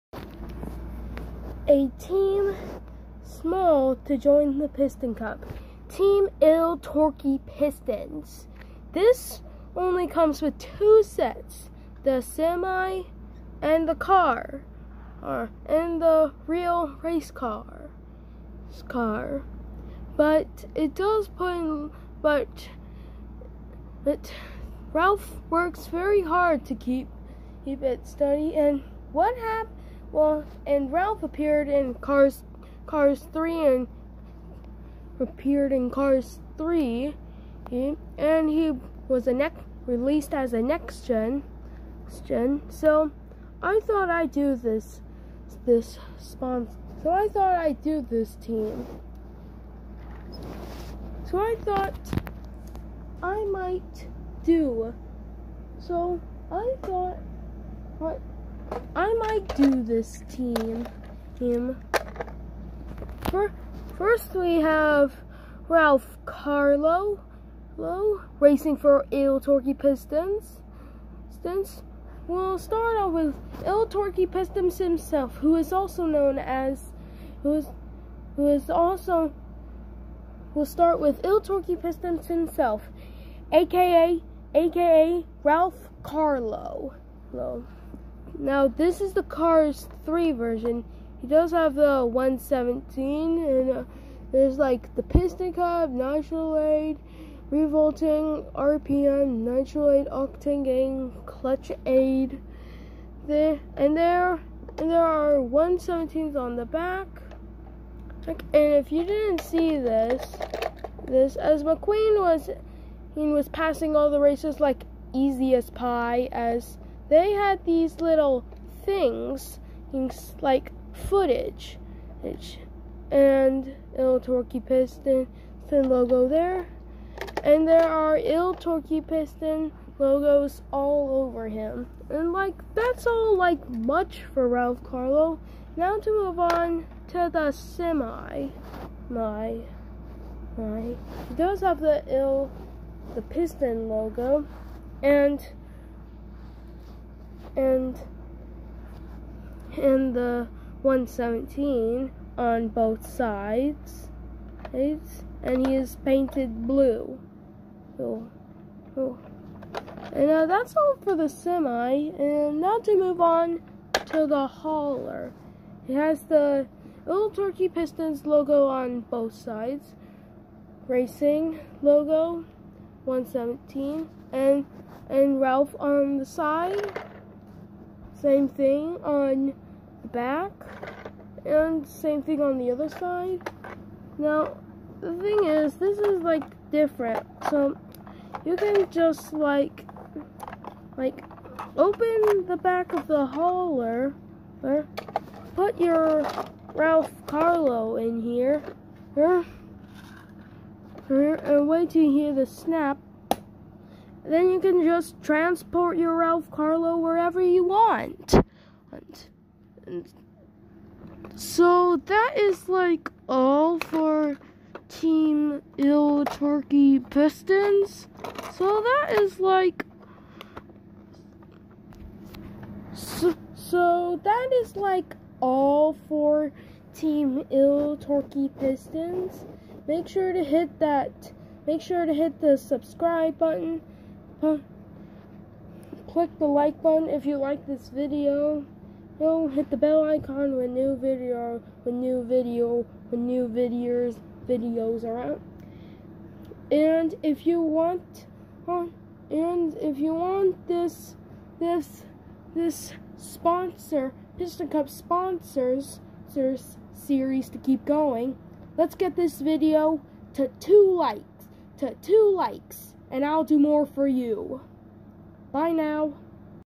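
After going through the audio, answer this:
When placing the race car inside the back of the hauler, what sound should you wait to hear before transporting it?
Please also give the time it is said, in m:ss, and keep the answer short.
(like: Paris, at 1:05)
Snap, at 3:22.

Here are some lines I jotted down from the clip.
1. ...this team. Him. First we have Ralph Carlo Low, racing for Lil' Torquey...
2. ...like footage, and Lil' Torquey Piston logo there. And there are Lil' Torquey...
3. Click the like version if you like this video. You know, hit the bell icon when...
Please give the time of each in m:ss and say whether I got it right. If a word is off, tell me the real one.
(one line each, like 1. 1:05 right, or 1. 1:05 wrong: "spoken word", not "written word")
1. 0:59 right
2. 2:00 right
3. 3:54 wrong: "button", not "version".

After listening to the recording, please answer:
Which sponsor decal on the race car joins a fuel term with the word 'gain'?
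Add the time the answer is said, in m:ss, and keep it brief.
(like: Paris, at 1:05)
Octane Gain, at 1:40.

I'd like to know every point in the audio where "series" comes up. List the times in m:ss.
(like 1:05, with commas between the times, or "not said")
4:17.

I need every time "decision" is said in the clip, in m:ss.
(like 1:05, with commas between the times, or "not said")
not said.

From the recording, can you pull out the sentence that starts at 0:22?
But, but Ralph works very hard to keep keep it steady.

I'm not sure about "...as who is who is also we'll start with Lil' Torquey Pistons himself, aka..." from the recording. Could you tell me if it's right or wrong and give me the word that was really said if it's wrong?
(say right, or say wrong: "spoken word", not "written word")
right.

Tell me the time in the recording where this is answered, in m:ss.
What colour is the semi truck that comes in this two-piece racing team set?
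2:36.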